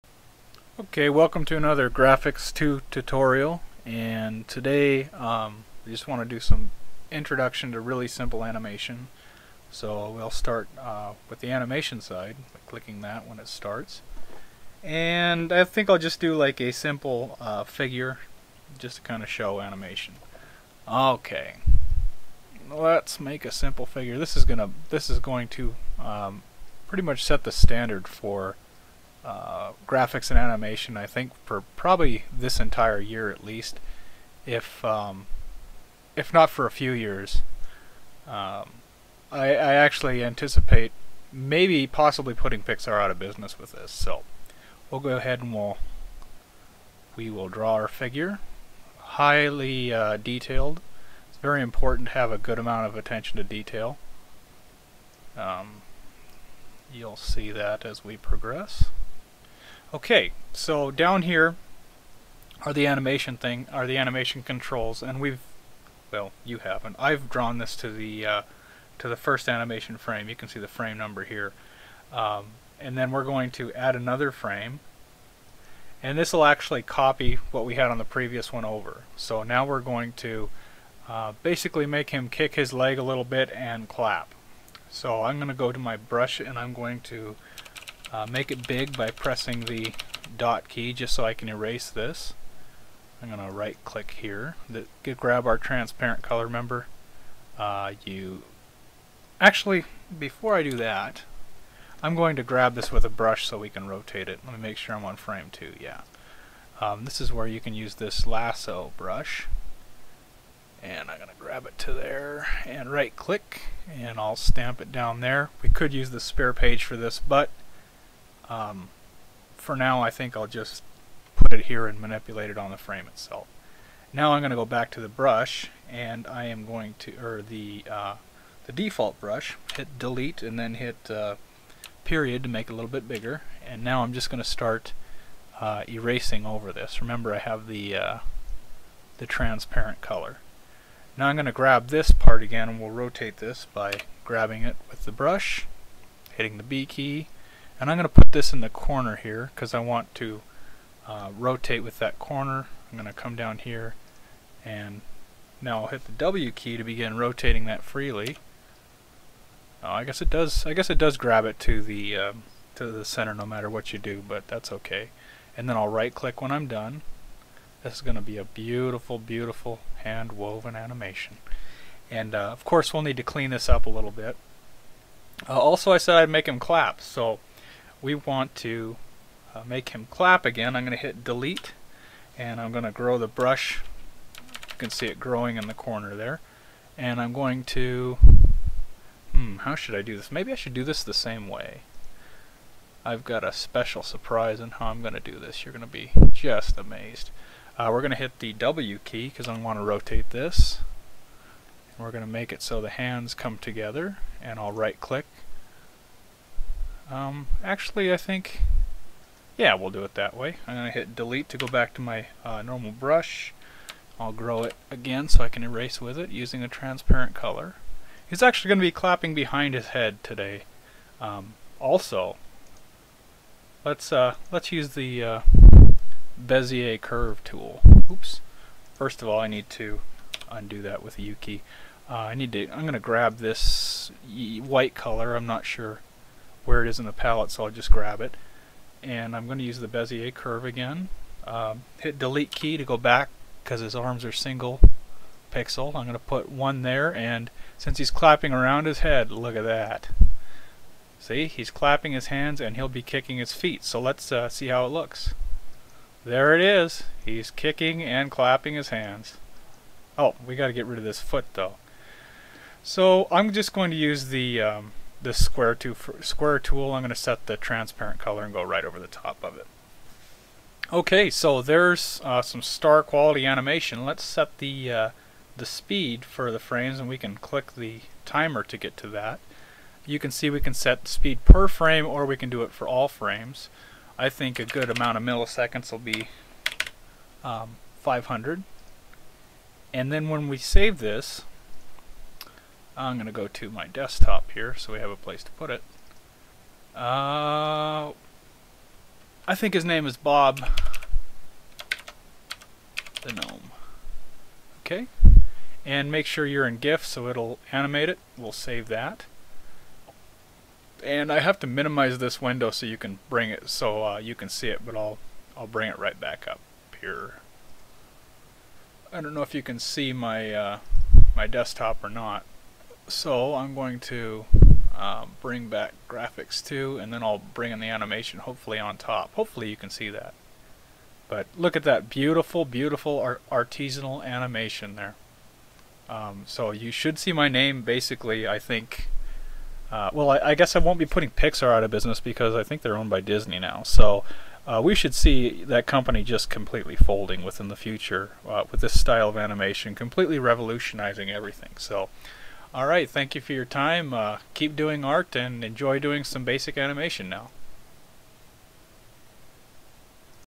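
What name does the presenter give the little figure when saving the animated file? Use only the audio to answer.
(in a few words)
Bob the Gnome.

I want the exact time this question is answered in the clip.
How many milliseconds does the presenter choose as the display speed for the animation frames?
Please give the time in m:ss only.
4:48.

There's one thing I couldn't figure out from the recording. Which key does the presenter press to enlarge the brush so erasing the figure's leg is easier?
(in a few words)
dot key.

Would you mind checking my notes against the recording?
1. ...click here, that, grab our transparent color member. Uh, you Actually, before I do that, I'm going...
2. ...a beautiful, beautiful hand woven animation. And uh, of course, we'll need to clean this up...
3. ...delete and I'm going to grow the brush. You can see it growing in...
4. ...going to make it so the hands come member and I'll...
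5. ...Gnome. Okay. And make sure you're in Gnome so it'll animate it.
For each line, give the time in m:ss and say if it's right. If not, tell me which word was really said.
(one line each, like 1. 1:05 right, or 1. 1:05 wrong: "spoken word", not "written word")
1. 1:33 right
2. 2:48 right
3. 3:01 right
4. 3:22 wrong: "together", not "member"
5. 5:03 wrong: "GIF", not "Gnome".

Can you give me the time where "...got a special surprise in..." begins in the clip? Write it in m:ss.
3:13.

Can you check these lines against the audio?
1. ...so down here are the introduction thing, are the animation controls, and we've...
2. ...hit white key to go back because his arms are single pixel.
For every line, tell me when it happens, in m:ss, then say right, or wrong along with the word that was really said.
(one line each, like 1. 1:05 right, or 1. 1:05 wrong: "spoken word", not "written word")
1. 1:00 wrong: "animation", not "introduction"
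2. 4:01 wrong: "delete", not "white".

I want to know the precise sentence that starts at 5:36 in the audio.
Um, so you should see my name basically, I think.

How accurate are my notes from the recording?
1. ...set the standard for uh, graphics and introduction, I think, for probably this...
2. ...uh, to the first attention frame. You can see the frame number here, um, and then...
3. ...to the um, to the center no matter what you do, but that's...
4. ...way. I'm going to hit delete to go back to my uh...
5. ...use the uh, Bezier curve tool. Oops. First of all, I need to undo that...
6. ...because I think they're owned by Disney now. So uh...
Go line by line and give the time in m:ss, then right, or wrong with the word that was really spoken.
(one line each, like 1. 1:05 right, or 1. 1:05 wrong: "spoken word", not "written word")
1. 0:27 wrong: "animation", not "introduction"
2. 1:08 wrong: "animation", not "attention"
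3. 2:41 right
4. 3:30 right
5. 3:44 right
6. 5:42 right.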